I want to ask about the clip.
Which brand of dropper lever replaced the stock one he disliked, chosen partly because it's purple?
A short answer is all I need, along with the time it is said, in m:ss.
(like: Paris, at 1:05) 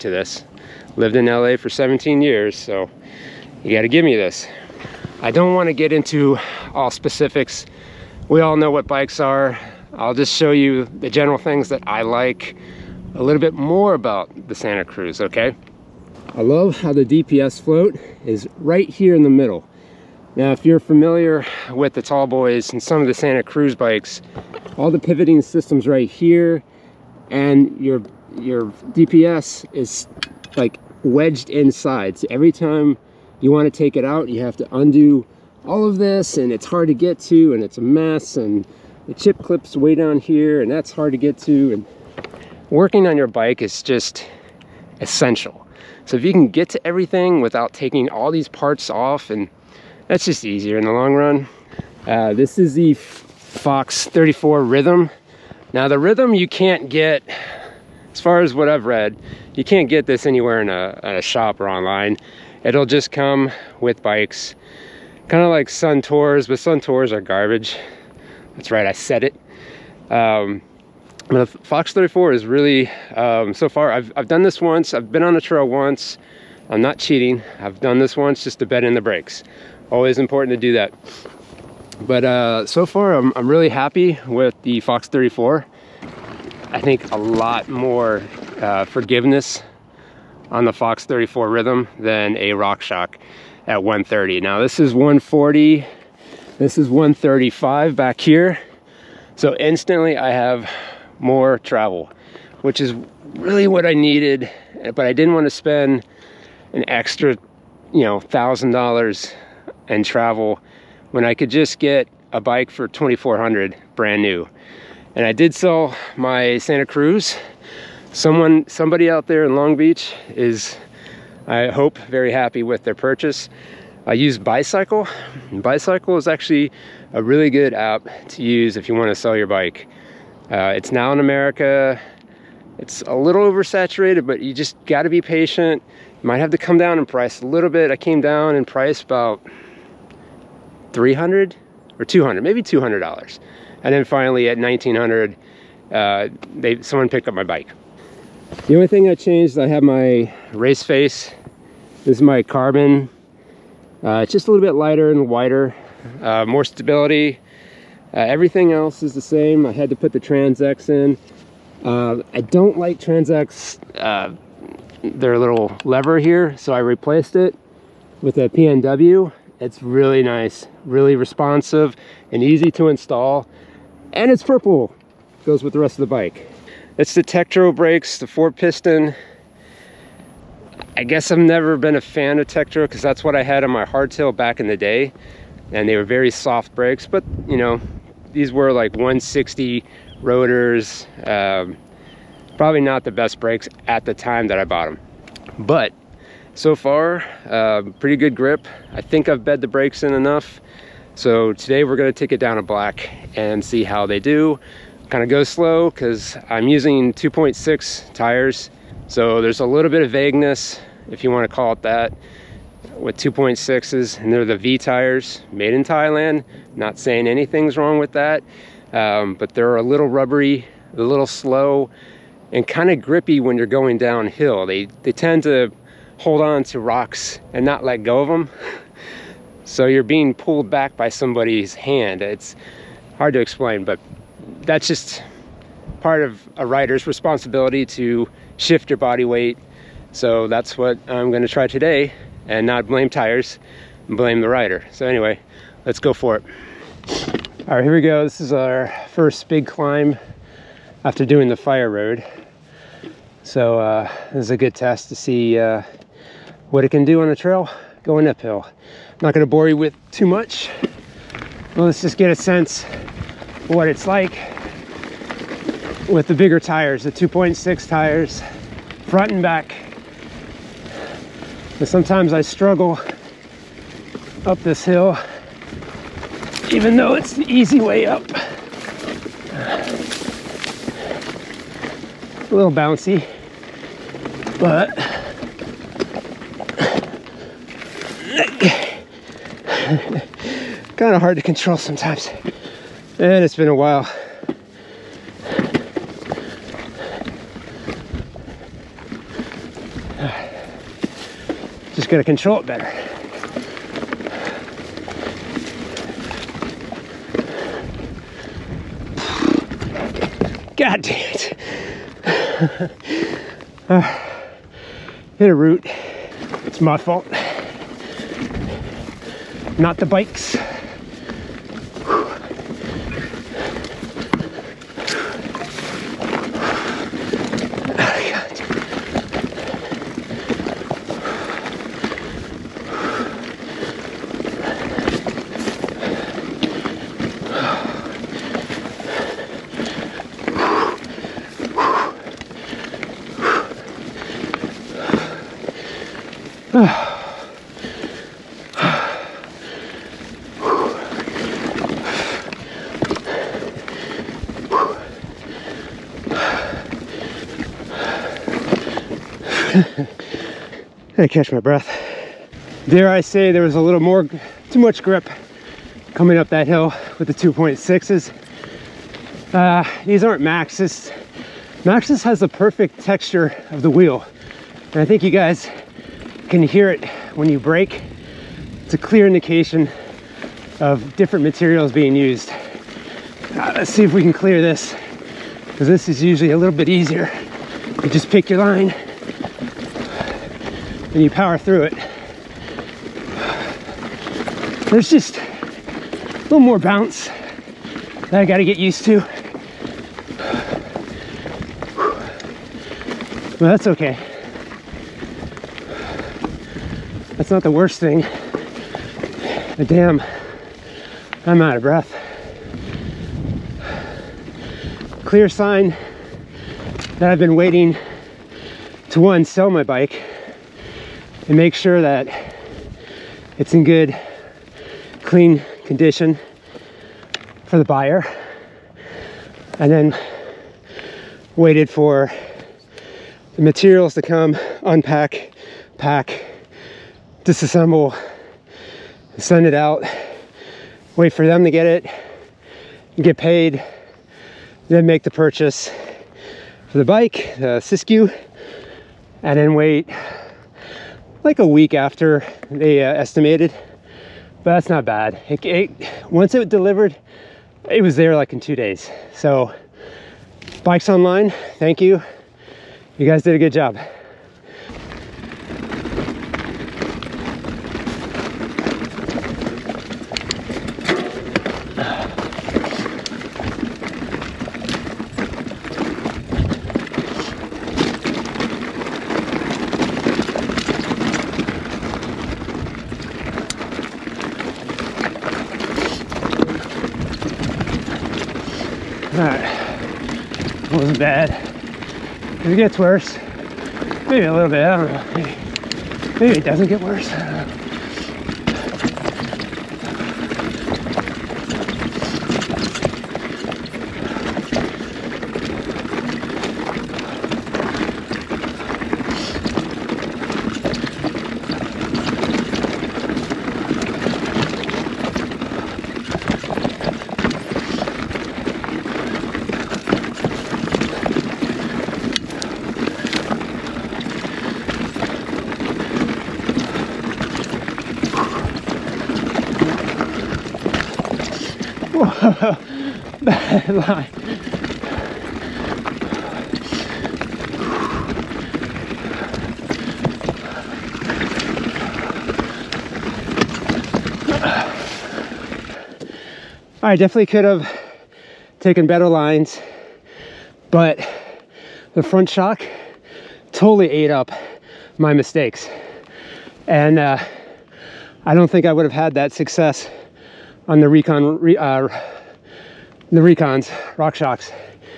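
PNW, at 2:48.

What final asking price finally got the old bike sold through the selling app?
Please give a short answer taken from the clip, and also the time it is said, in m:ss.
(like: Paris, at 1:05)
$1900, at 2:24.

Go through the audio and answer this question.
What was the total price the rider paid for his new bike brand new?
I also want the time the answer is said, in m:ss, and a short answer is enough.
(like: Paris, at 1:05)
$2400, at 1:52.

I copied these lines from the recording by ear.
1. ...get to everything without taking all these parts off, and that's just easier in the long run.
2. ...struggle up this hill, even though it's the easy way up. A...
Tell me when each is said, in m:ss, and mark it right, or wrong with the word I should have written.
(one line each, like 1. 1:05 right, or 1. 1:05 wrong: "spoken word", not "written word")
1. 0:46 right
2. 4:32 right.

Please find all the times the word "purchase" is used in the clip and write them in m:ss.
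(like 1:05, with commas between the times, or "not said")
2:02, 7:25.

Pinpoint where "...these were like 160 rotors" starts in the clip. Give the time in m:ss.
3:08.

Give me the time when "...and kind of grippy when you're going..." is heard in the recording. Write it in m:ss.
3:42.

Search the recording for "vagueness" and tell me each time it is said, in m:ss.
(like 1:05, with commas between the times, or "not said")
3:30.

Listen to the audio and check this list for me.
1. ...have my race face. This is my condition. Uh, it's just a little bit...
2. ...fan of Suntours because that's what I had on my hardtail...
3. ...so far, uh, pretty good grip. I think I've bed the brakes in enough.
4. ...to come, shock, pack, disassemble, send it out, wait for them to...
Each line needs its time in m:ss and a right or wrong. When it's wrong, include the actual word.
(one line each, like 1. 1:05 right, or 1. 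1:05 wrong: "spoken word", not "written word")
1. 2:29 wrong: "carbon", not "condition"
2. 3:02 wrong: "Tektro", not "Suntours"
3. 3:16 right
4. 7:14 wrong: "unpack", not "shock".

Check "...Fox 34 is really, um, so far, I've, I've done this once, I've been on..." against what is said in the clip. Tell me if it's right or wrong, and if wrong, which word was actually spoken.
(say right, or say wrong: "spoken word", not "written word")
right.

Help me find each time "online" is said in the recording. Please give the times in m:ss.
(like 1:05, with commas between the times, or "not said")
1:01, 7:41.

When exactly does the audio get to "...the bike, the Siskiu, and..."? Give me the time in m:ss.
7:26.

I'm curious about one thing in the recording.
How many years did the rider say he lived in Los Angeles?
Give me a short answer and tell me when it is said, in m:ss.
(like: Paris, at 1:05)
17, at 0:01.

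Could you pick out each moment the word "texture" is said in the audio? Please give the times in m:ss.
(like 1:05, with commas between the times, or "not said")
6:12.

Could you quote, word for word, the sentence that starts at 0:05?
I don't want to get into all specifics.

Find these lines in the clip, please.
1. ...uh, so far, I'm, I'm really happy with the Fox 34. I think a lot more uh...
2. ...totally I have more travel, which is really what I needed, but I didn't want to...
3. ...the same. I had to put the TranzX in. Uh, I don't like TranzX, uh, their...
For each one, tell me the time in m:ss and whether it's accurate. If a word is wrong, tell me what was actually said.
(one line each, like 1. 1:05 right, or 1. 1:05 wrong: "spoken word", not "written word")
1. 1:22 right
2. 1:39 wrong: "instantly", not "totally"
3. 2:39 right.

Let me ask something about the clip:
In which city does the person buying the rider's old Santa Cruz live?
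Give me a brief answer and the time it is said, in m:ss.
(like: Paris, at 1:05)
Long Beach, at 1:59.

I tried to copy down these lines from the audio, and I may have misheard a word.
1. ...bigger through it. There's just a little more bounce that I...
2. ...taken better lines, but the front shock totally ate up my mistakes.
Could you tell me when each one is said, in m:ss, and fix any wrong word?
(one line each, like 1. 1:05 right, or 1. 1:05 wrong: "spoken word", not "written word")
1. 6:31 wrong: "power", not "bigger"
2. 9:08 right.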